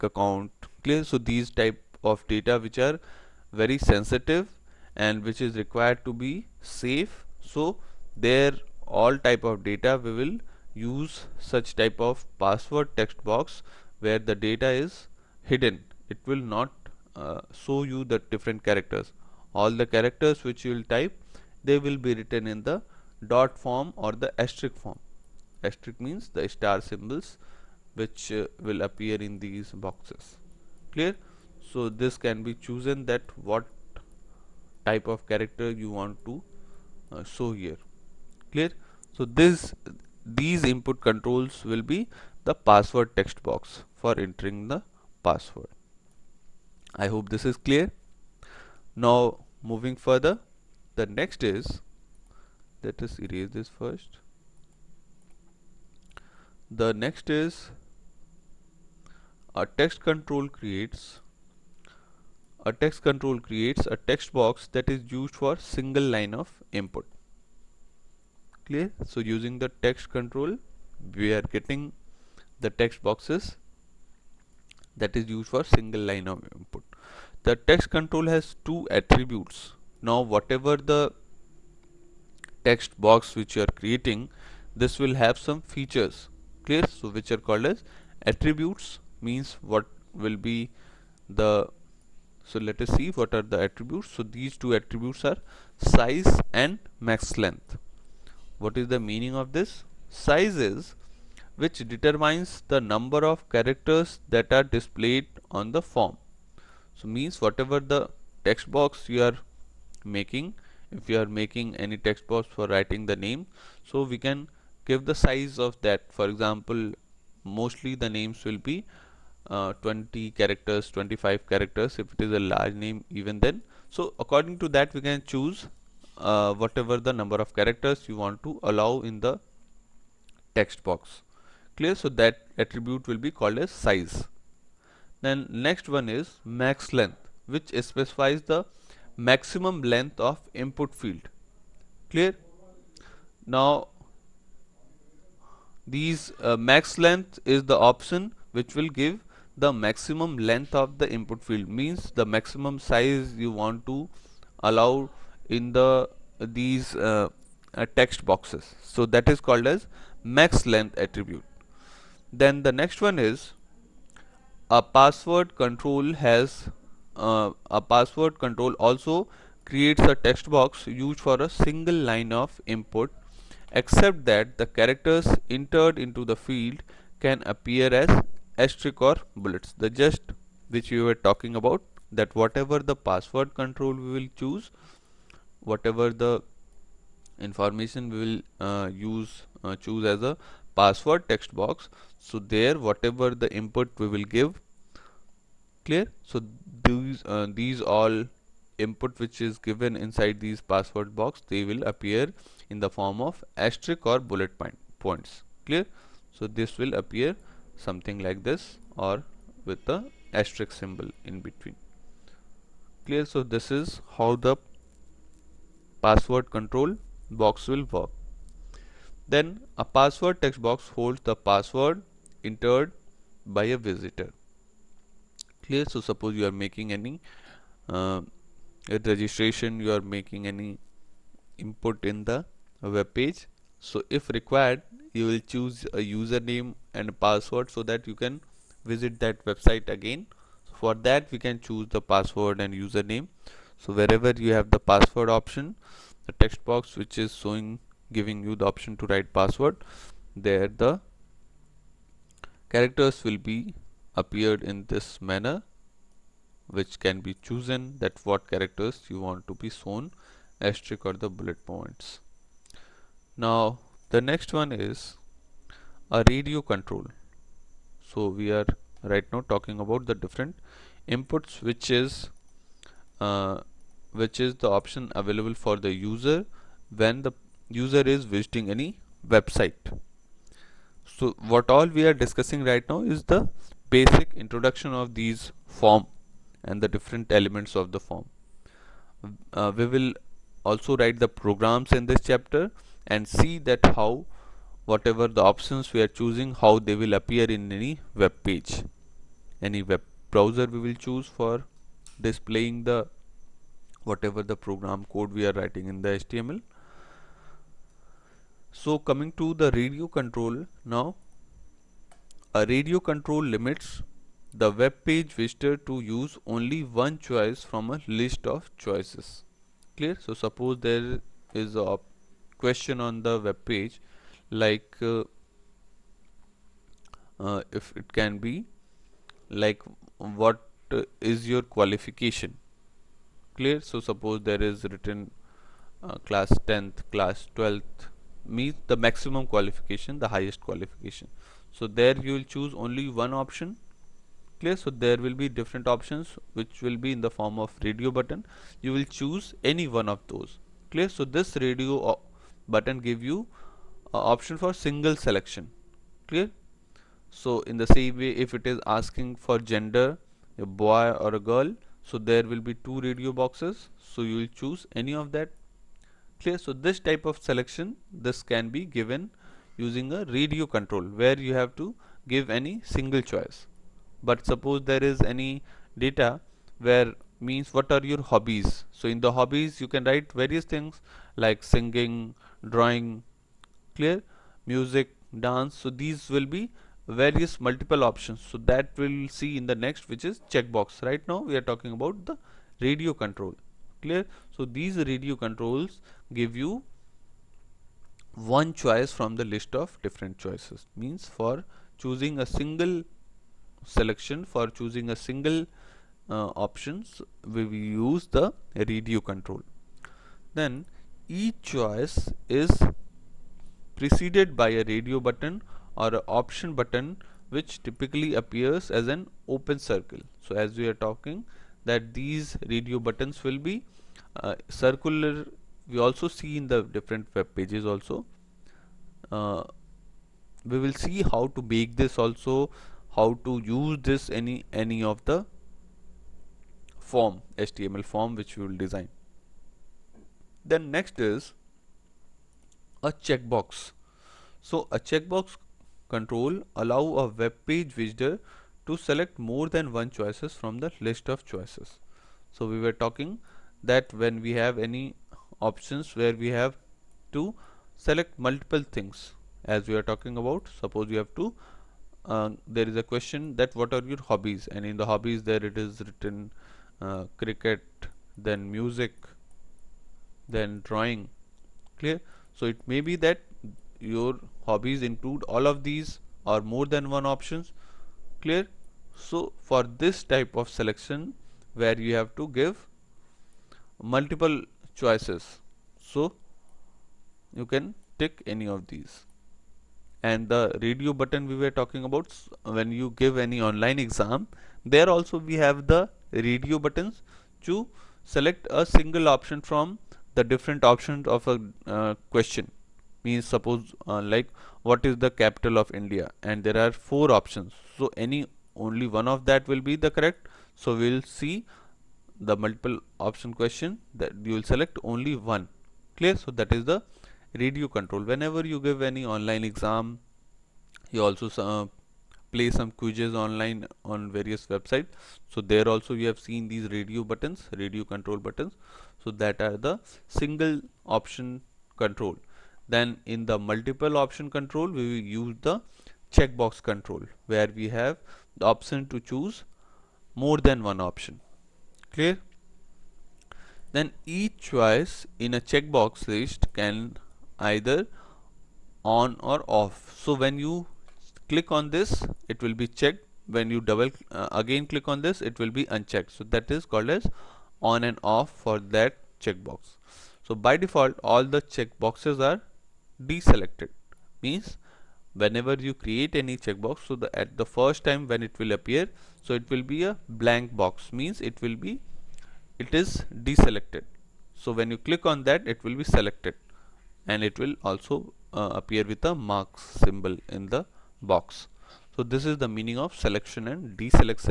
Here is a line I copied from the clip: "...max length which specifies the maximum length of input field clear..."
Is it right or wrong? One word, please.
right.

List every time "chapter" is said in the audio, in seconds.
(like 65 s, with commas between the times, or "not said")
292 s.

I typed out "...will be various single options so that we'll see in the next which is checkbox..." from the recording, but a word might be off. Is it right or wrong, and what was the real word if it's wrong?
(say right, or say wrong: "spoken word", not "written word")
wrong: "multiple", not "single".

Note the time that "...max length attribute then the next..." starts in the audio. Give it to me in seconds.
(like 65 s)
160 s.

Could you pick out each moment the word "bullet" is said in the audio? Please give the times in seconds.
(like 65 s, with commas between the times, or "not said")
179 s, 204 s, 261 s.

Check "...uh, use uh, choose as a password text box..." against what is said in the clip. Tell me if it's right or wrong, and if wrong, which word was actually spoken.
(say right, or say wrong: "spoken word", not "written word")
right.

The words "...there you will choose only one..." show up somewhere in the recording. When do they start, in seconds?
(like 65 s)
341 s.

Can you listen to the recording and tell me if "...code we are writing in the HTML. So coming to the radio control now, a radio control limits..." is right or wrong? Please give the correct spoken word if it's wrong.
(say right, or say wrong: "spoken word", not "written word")
right.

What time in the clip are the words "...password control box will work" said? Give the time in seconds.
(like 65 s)
216 s.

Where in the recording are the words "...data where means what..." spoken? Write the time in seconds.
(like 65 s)
375 s.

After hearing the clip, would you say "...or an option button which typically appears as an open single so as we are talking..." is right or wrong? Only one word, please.
wrong.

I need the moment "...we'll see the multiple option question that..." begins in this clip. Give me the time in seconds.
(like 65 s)
510 s.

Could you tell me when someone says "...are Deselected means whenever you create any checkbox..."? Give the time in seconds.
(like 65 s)
562 s.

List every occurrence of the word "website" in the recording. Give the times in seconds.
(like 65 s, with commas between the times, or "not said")
239 s, 279 s, 524 s.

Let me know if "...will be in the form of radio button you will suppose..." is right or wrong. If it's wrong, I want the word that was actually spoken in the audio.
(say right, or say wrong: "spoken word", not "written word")
wrong: "choose", not "suppose".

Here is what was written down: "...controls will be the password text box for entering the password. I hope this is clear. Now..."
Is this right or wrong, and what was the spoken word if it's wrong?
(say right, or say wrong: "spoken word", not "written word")
right.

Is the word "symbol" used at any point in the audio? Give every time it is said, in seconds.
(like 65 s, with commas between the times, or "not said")
26 s, 210 s, 580 s.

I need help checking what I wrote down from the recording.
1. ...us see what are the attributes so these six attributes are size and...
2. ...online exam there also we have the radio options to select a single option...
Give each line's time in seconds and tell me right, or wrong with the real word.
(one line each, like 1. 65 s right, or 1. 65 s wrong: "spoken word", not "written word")
1. 92 s wrong: "two", not "six"
2. 493 s wrong: "buttons", not "options".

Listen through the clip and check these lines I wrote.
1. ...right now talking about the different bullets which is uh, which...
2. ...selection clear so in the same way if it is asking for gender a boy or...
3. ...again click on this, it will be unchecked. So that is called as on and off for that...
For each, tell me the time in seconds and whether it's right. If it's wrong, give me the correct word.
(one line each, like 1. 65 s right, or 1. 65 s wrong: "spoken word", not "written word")
1. 269 s wrong: "inputs", not "bullets"
2. 355 s right
3. 554 s right.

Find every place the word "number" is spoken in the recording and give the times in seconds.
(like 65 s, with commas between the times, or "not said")
102 s, 127 s.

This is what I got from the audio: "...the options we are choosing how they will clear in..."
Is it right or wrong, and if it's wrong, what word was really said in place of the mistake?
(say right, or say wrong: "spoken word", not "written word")
wrong: "appear", not "clear".